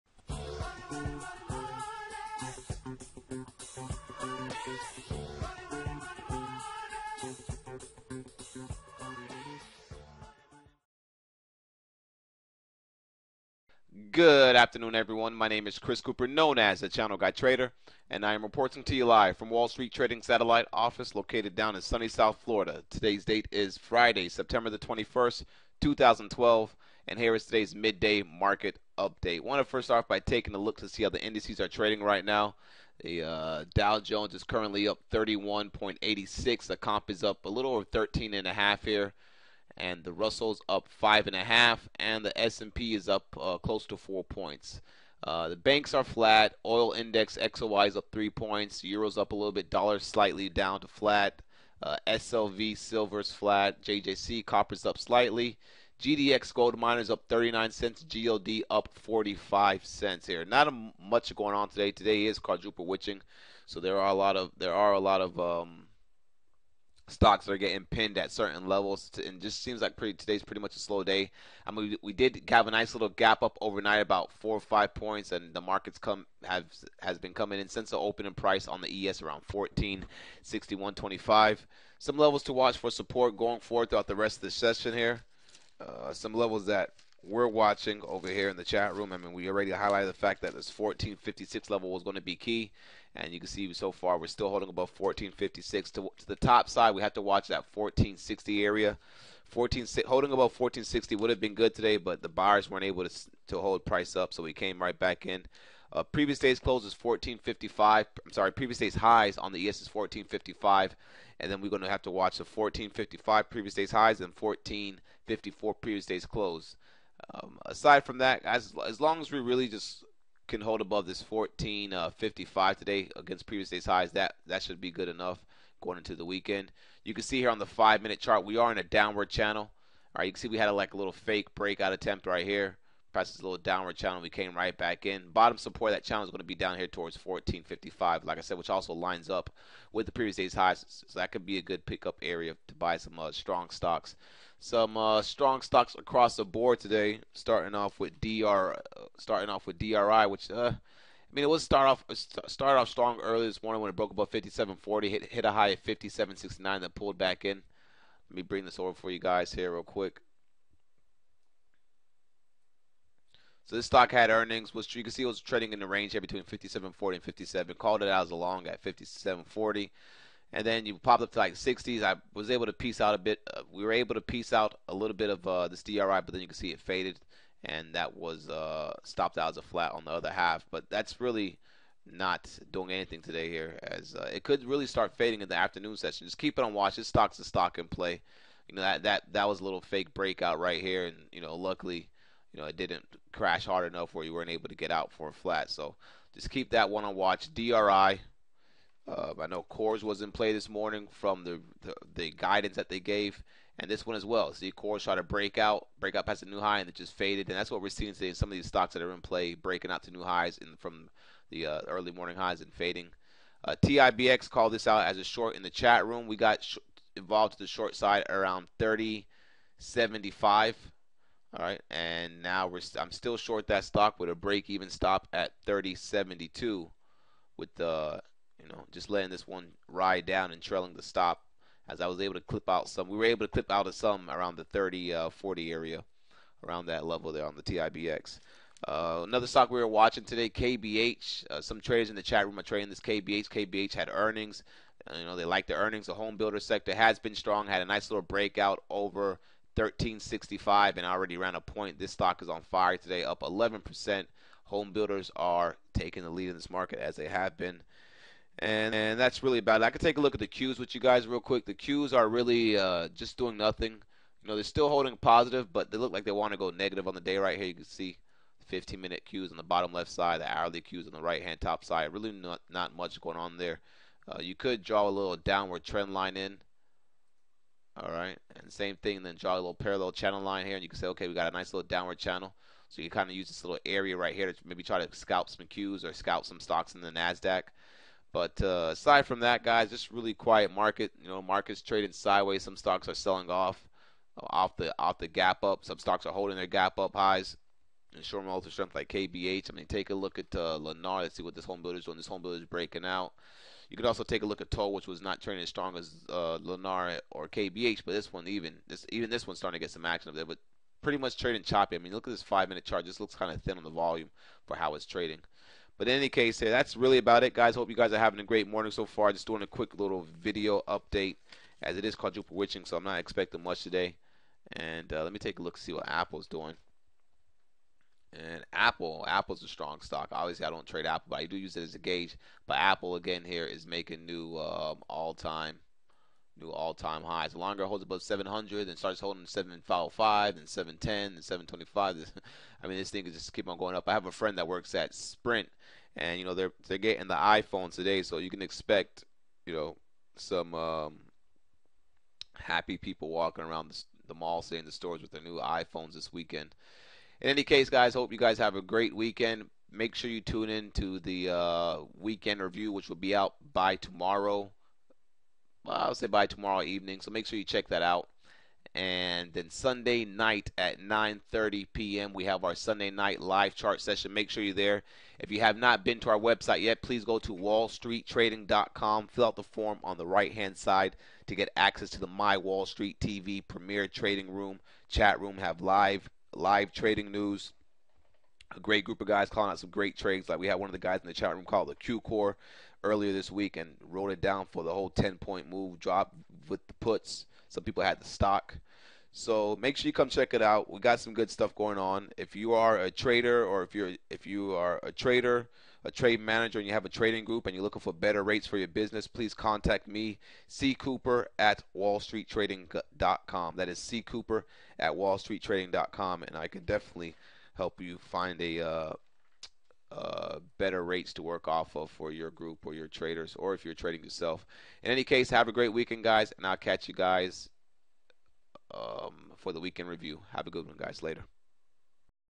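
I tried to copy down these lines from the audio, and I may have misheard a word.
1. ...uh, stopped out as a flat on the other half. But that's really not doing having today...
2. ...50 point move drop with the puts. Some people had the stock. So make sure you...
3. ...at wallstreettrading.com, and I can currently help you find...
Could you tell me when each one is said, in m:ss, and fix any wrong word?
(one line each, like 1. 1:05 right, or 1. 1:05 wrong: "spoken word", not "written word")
1. 2:58 wrong: "anything", not "having"
2. 6:35 wrong: "10", not "50"
3. 6:54 wrong: "definitely", not "currently".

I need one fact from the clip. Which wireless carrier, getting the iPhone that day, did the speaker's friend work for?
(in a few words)
Sprint.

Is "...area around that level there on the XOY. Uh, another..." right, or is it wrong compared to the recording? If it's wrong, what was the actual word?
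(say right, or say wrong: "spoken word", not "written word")
wrong: "TIBX", not "XOY".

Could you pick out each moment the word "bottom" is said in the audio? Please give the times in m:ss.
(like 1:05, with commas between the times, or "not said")
2:15, 4:29.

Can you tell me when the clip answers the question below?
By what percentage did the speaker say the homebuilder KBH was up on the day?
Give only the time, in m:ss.
4:13.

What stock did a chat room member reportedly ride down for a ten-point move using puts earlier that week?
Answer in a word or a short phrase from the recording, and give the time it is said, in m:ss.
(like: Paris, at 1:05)
QCOR, at 6:31.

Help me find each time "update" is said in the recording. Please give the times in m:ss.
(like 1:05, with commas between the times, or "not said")
0:29, 5:20.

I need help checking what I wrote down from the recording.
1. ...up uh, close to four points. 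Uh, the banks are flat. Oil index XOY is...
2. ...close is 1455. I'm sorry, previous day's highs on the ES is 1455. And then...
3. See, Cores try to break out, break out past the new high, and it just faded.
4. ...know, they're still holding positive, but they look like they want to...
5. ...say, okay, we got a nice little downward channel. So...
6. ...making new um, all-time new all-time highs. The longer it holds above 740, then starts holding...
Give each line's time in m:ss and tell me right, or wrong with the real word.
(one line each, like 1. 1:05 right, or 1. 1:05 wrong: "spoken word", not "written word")
1. 0:43 right
2. 1:46 right
3. 3:24 right
4. 4:24 right
5. 4:40 right
6. 5:33 wrong: "700", not "740".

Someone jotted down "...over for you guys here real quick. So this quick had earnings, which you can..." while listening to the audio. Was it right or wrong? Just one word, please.
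wrong.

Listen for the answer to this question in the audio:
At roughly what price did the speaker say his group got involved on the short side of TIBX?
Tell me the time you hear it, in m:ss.
3:38.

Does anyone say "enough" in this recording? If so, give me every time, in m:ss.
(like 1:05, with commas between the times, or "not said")
2:05, 3:13.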